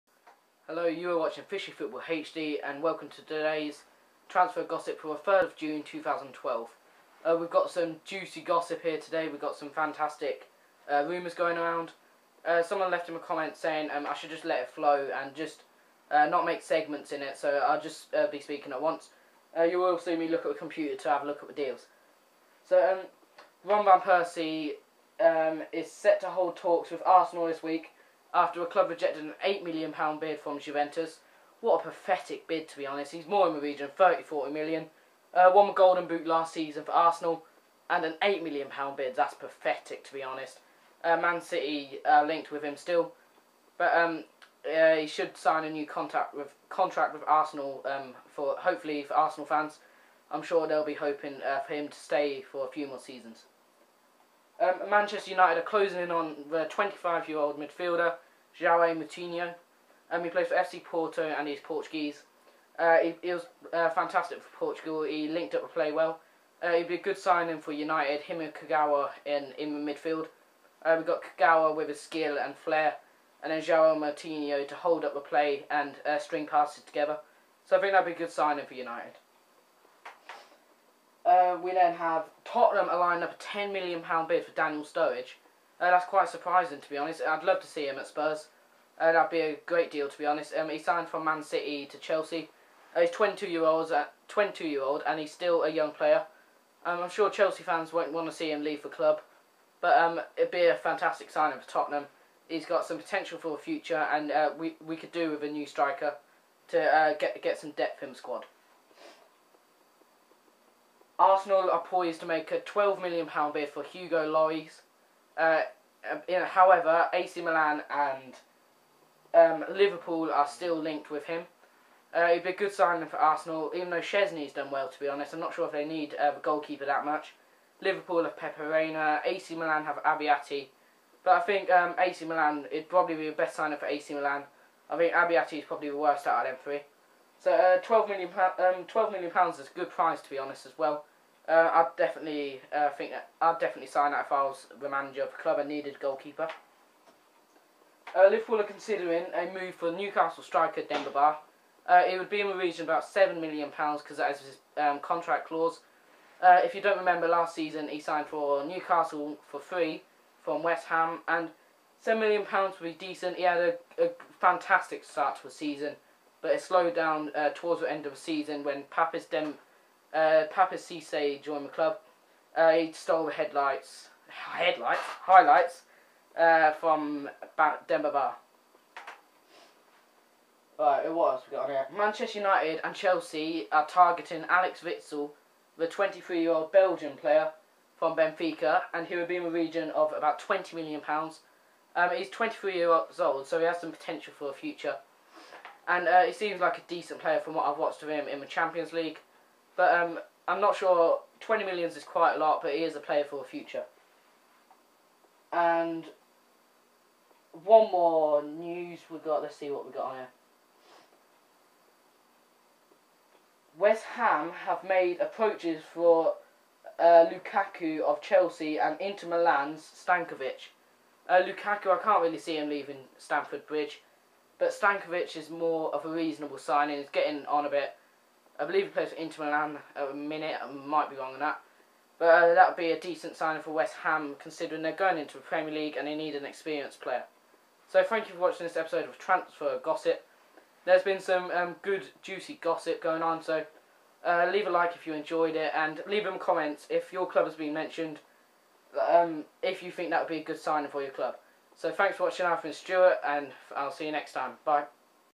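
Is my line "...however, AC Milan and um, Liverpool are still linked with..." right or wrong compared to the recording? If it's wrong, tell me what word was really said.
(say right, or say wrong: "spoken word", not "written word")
right.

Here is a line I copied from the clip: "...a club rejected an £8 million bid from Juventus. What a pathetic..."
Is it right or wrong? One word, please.
right.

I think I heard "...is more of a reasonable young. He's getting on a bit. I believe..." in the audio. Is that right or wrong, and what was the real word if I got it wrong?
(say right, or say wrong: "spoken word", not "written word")
wrong: "signing", not "young".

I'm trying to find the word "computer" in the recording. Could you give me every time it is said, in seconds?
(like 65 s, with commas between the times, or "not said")
20 s.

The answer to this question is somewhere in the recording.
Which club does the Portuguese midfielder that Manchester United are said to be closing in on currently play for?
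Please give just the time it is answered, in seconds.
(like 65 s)
60 s.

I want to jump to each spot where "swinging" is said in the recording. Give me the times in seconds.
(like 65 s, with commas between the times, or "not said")
not said.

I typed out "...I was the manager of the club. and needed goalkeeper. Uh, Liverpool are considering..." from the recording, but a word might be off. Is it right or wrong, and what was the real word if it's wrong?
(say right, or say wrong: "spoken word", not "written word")
right.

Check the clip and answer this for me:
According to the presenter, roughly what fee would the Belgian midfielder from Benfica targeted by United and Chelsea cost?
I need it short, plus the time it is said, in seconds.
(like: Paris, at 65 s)
£20 million, at 190 s.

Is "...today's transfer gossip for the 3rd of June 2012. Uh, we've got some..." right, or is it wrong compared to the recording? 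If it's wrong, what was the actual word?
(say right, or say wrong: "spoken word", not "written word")
right.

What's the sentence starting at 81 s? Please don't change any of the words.
Uh, we then have Tottenham are lining up a ten million pound bid for Daniel Sturridge.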